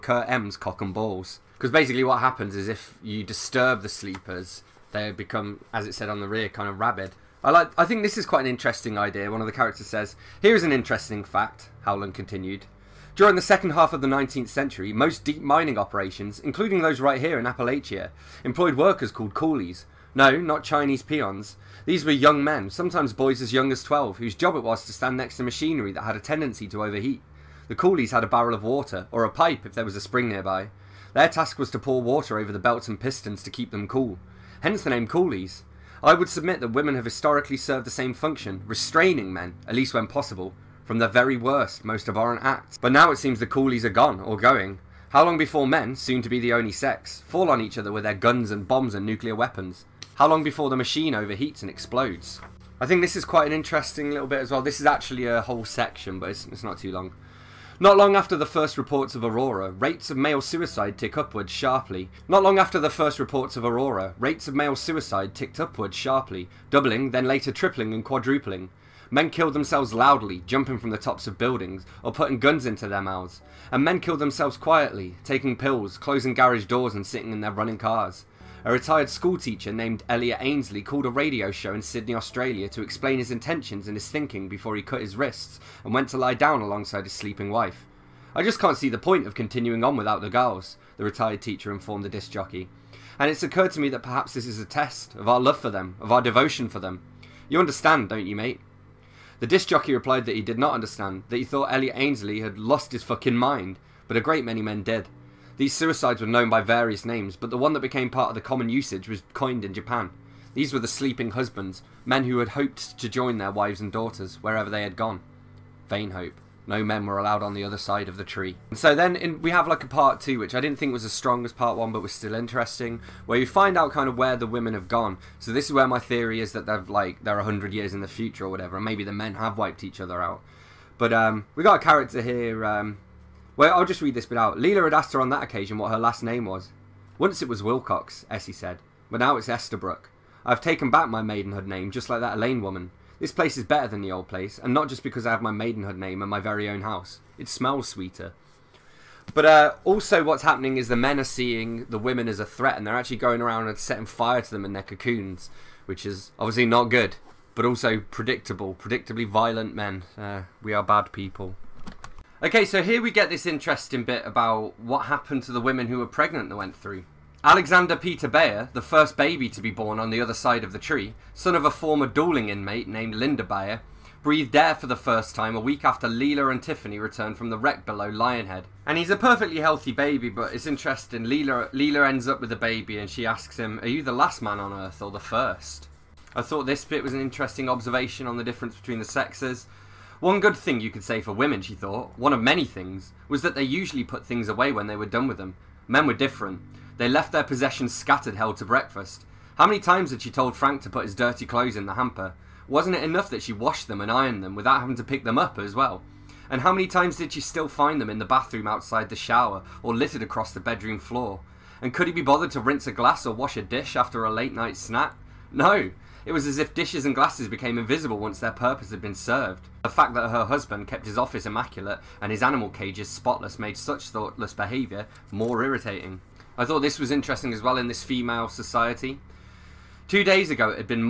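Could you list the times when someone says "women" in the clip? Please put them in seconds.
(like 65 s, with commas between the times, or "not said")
36 s, 124 s, 151 s, 165 s, 191 s.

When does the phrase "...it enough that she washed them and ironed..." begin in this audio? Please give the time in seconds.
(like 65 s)
202 s.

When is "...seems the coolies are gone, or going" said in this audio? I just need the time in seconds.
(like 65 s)
43 s.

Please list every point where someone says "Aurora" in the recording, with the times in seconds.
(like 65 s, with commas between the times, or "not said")
59 s, 63 s.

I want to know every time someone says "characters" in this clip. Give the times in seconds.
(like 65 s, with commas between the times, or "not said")
9 s, 131 s.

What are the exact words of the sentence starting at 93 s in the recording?
And it's occurred to me that perhaps this is a test of our love for them, of our devotion for them.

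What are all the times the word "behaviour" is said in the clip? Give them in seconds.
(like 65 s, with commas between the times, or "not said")
224 s.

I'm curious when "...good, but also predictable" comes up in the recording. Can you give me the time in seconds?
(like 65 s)
156 s.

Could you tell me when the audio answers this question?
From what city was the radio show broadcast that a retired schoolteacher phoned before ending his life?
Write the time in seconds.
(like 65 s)
81 s.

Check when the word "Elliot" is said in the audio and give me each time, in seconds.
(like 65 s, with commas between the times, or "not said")
80 s, 101 s.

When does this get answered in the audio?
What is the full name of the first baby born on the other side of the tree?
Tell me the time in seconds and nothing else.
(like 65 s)
167 s.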